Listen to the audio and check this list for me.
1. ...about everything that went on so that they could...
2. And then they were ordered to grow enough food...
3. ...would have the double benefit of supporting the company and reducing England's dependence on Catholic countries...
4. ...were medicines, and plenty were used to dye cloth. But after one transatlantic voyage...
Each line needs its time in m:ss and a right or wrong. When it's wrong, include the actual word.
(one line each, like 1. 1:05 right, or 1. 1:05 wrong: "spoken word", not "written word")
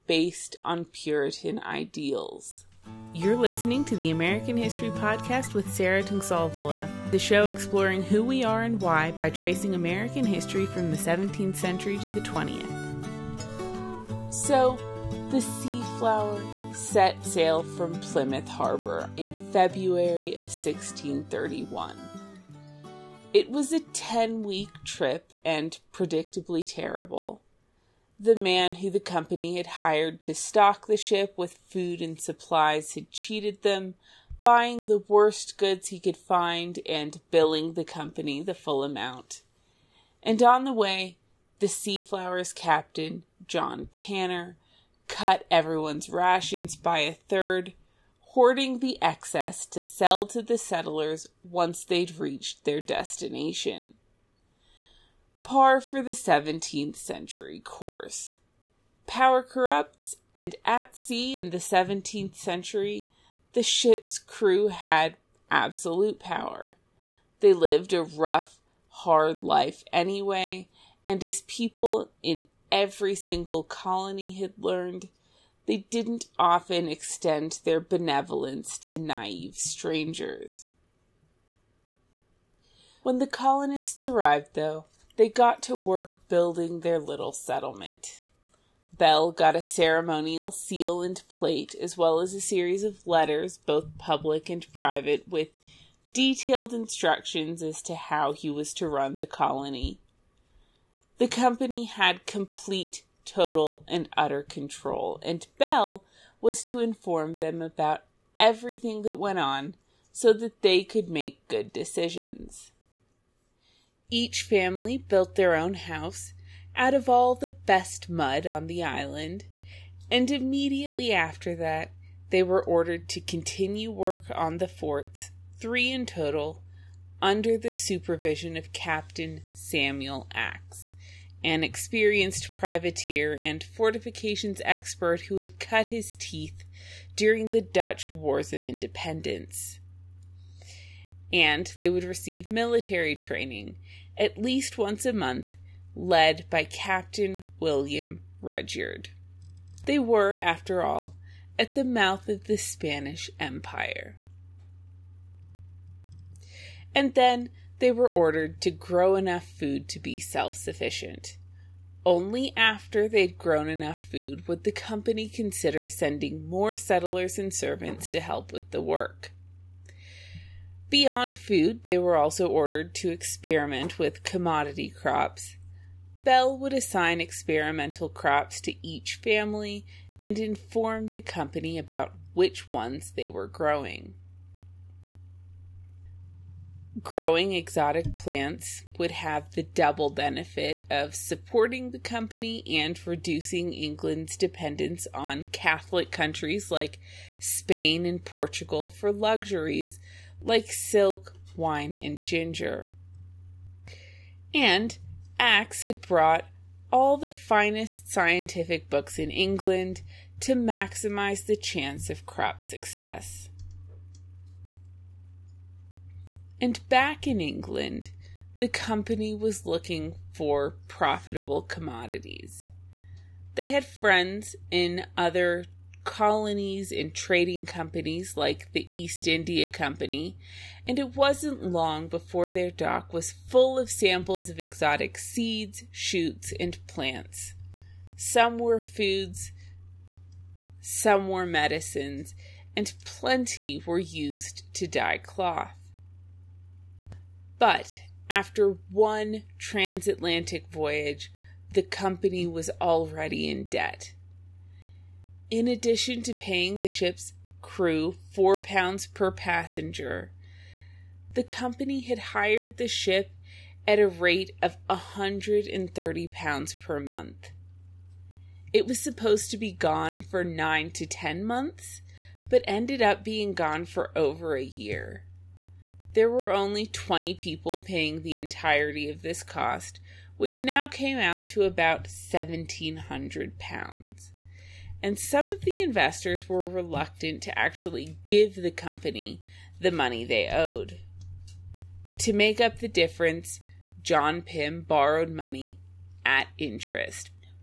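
1. 1:47 right
2. 2:36 right
3. 3:08 right
4. 4:01 right.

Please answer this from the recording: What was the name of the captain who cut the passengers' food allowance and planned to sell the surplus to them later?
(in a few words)
John Tanner.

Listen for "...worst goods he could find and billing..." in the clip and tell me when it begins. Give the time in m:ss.
0:35.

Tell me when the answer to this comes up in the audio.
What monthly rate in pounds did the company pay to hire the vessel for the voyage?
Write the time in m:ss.
4:24.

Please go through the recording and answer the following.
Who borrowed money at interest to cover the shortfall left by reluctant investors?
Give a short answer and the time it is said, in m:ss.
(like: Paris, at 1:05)
John Pym, at 4:54.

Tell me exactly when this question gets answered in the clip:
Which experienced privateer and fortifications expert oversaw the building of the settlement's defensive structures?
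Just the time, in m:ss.
2:09.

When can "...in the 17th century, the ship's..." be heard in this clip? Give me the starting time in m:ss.
1:01.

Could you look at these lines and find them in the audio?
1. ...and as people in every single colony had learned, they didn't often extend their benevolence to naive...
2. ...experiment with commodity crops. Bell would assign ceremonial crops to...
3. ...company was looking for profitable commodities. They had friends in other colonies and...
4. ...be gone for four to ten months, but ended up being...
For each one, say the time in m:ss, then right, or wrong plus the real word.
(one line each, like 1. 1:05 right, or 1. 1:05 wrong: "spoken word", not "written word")
1. 1:11 right
2. 2:53 wrong: "experimental", not "ceremonial"
3. 3:38 right
4. 4:29 wrong: "nine", not "four".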